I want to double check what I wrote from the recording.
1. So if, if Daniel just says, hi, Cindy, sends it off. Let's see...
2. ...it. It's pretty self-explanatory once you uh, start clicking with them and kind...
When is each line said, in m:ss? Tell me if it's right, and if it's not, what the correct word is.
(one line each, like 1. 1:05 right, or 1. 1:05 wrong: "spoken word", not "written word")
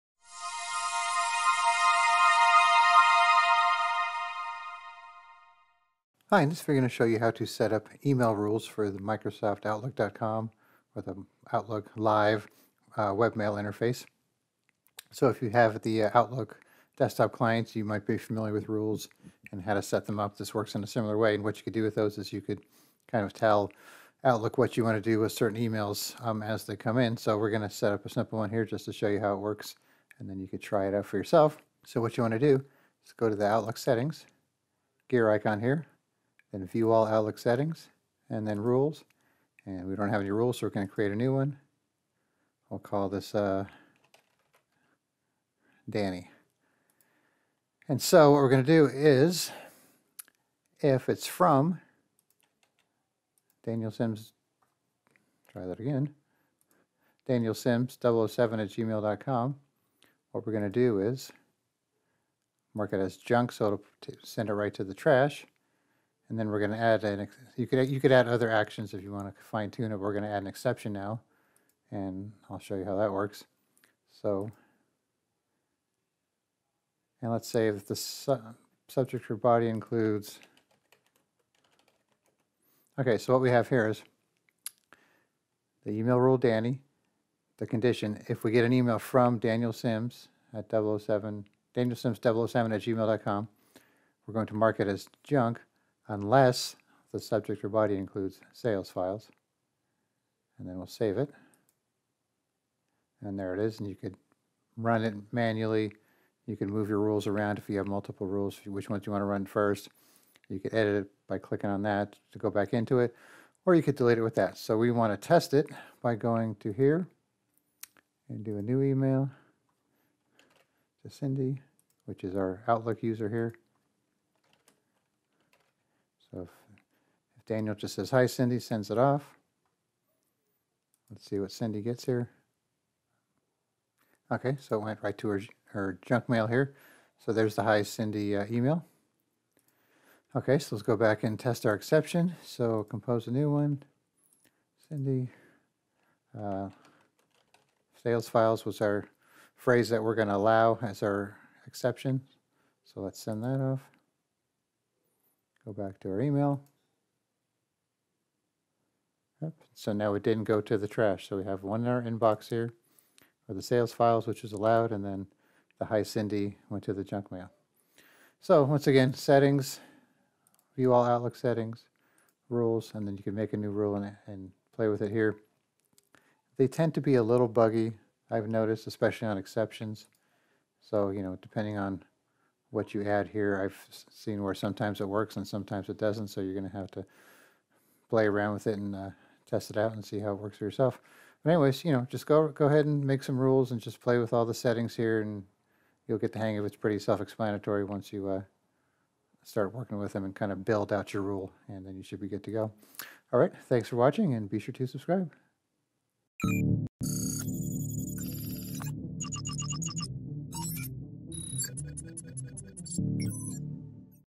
1. 2:06 right
2. 3:16 wrong: "working", not "clicking".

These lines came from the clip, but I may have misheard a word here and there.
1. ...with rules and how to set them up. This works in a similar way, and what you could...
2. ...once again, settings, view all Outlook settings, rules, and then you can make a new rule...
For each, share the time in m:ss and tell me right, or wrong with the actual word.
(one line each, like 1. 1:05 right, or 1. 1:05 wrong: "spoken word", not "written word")
1. 0:18 right
2. 2:48 right.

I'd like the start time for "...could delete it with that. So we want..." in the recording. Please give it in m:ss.
1:53.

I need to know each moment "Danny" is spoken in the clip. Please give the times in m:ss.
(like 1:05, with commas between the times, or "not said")
0:45, 1:26.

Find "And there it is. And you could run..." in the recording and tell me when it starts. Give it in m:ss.
1:43.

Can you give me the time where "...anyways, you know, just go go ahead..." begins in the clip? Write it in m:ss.
3:11.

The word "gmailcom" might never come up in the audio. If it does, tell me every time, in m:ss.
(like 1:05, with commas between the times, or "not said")
0:58, 1:32.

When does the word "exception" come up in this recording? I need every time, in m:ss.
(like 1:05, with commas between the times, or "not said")
1:10, 2:21, 2:31, 2:59.